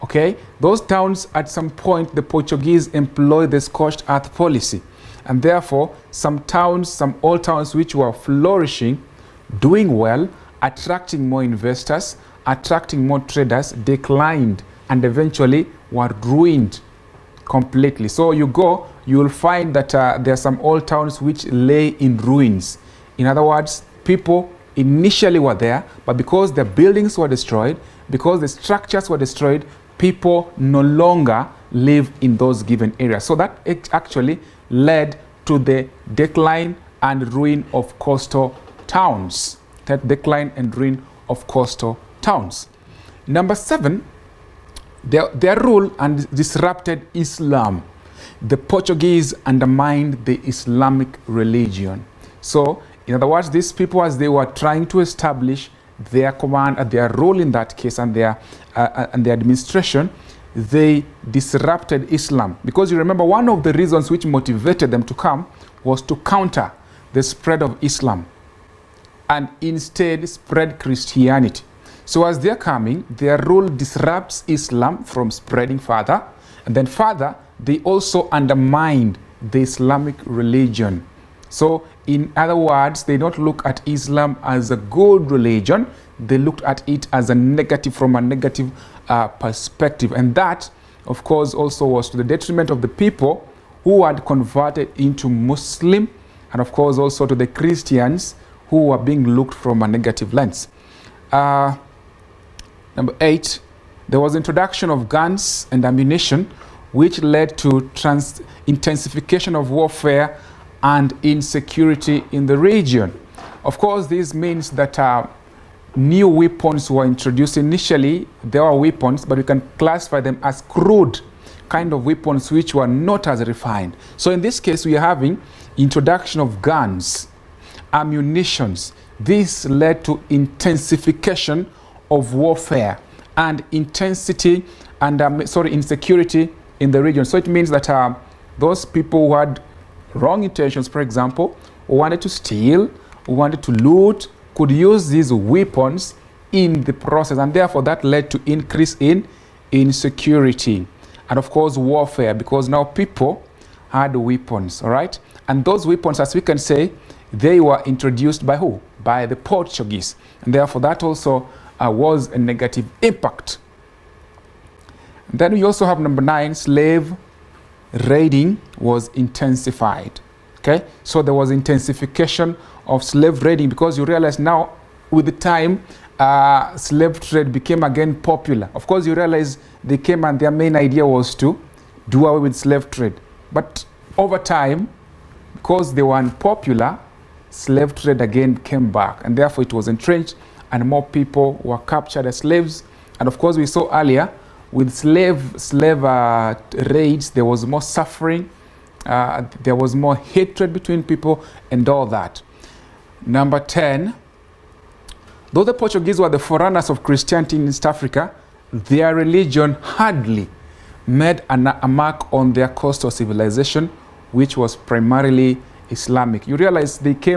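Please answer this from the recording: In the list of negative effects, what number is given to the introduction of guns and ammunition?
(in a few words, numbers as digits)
8.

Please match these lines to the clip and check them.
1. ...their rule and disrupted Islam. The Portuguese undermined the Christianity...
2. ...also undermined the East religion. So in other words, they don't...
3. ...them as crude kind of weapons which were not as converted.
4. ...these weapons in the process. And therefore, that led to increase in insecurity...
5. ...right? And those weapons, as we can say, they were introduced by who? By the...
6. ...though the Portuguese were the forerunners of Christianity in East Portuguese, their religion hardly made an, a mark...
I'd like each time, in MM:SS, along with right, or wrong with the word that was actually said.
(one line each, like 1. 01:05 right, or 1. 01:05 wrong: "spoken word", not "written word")
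1. 00:45 wrong: "Islamic", not "Christianity"
2. 01:17 wrong: "Islamic", not "East"
3. 02:00 wrong: "refined", not "converted"
4. 02:25 right
5. 02:34 right
6. 03:25 wrong: "Africa", not "Portuguese".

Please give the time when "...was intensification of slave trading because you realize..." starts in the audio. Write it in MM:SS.
02:51.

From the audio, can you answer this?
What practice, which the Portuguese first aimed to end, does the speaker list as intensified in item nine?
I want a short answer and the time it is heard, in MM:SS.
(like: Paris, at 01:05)
Slave raiding, at 02:46.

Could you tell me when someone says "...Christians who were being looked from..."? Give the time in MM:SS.
01:37.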